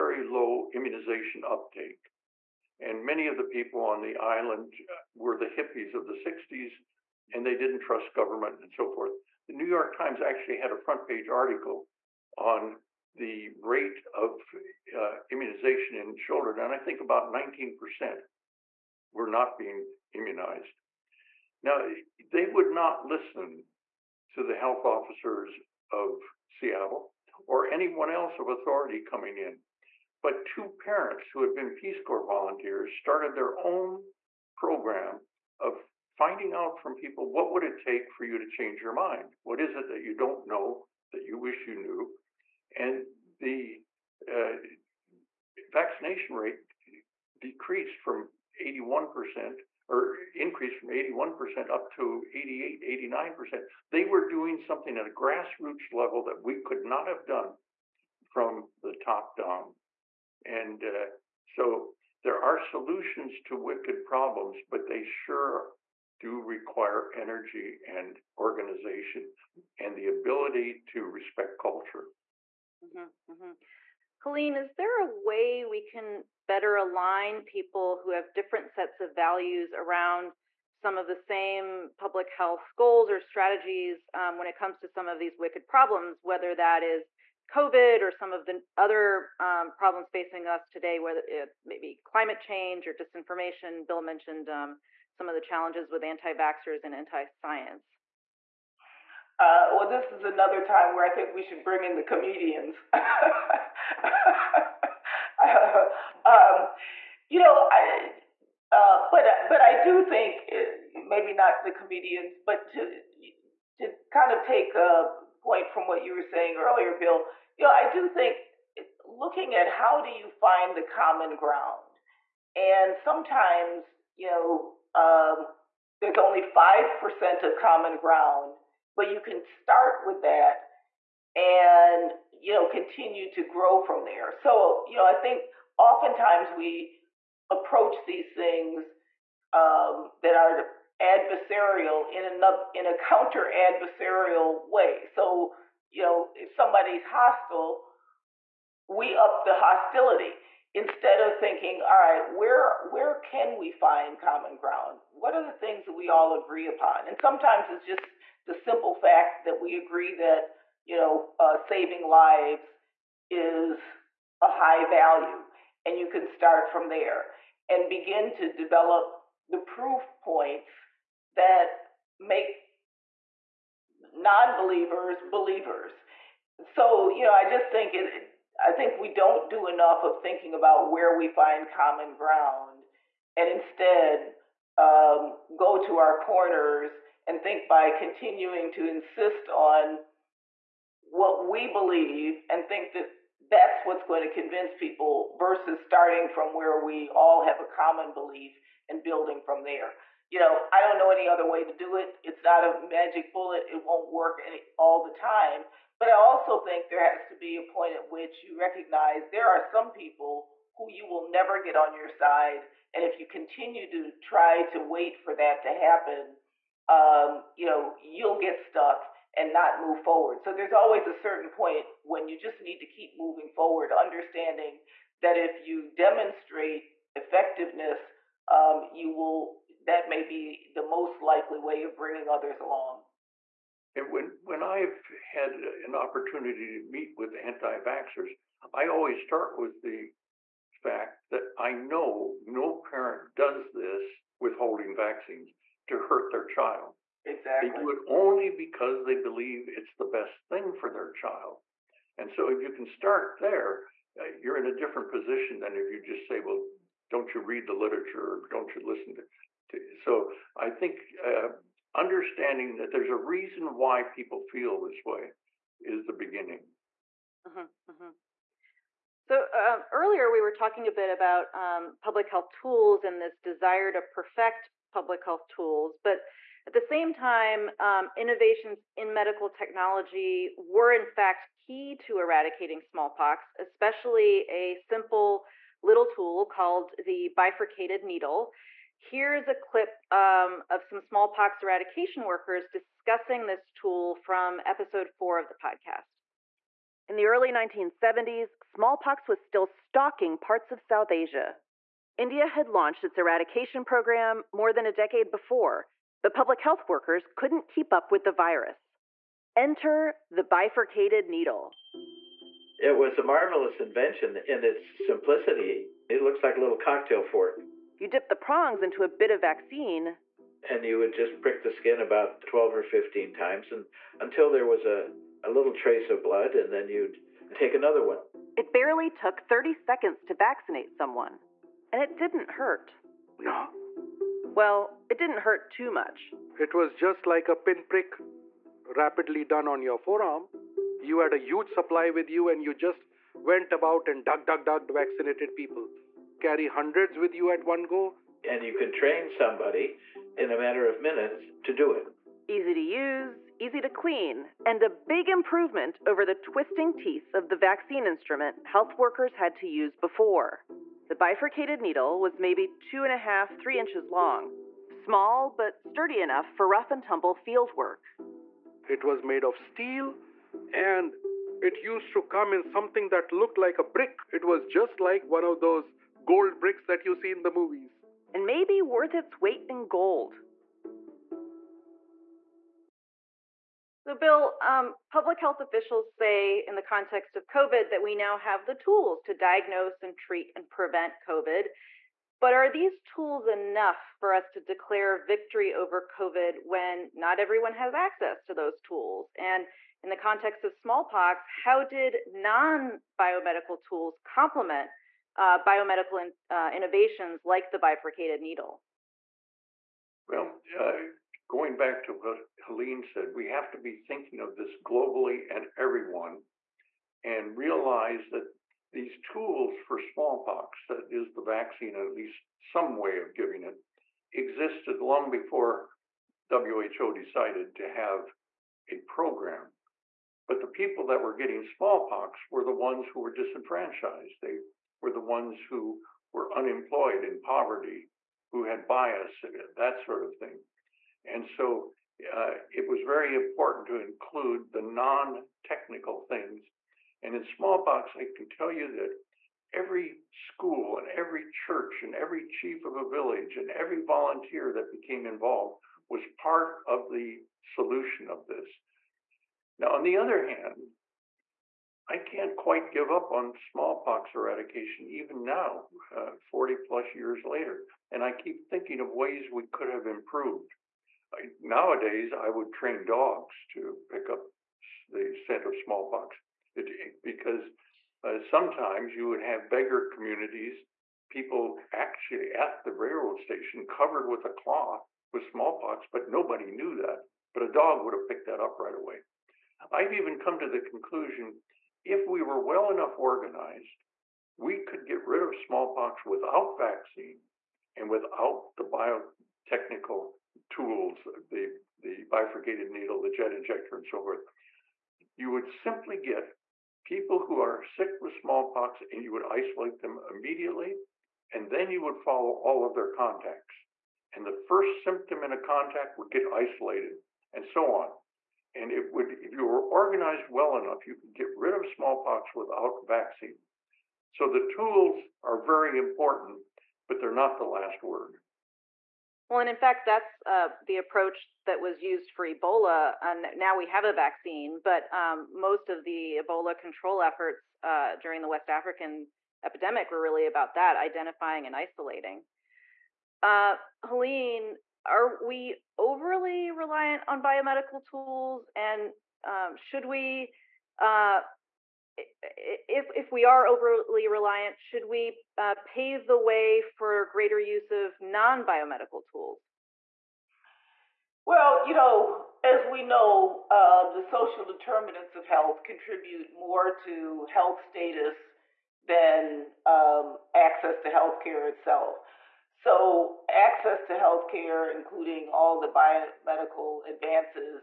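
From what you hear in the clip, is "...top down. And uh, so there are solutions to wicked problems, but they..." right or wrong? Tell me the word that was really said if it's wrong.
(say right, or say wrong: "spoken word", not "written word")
right.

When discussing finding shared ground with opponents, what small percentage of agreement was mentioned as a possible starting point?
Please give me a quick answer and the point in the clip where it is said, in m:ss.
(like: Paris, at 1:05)
5%, at 2:06.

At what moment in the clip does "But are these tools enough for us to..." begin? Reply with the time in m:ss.
6:32.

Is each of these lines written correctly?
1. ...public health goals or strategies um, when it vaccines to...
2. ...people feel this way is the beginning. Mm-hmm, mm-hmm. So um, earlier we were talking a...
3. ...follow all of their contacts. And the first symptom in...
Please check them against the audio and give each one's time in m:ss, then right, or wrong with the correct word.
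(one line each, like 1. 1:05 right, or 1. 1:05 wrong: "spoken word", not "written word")
1. 1:21 wrong: "comes", not "vaccines"
2. 4:24 right
3. 8:32 right.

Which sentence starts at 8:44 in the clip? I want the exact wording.
So the tools are very important, but they're not the last word.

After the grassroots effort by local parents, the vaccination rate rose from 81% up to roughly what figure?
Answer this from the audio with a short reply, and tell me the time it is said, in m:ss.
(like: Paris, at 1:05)
88-89%, at 0:52.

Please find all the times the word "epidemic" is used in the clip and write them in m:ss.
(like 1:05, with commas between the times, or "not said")
8:59.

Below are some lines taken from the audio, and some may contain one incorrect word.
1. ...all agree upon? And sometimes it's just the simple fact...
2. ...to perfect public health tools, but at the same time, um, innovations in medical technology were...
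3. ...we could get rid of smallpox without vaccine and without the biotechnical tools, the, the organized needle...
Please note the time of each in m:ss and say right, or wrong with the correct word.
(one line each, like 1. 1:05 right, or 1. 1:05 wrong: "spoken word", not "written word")
1. 2:36 right
2. 4:33 right
3. 8:14 wrong: "bifurcated", not "organized".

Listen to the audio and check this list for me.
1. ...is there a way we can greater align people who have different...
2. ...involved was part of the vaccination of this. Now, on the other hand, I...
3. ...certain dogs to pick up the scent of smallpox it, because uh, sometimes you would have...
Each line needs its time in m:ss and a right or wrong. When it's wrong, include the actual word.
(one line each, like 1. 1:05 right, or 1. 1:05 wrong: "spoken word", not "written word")
1. 1:14 wrong: "better", not "greater"
2. 7:35 wrong: "solution", not "vaccination"
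3. 7:52 wrong: "train", not "certain".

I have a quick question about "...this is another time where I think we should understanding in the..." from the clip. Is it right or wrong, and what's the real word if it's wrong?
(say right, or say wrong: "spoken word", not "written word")
wrong: "bring", not "understanding".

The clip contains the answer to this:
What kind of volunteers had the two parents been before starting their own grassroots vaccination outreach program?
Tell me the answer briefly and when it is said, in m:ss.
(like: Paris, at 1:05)
Peace Corps, at 0:31.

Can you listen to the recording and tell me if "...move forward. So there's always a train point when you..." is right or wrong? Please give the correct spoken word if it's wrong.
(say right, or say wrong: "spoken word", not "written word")
wrong: "certain", not "train".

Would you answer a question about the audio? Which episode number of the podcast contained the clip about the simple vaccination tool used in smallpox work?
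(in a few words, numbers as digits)
4.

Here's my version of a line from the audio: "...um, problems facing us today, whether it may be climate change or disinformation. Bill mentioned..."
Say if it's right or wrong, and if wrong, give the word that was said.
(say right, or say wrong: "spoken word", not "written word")
right.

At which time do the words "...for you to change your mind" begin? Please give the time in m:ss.
0:38.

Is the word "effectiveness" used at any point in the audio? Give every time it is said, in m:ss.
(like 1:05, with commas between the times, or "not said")
3:47.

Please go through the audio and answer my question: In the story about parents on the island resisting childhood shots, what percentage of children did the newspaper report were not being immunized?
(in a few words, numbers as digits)
19%.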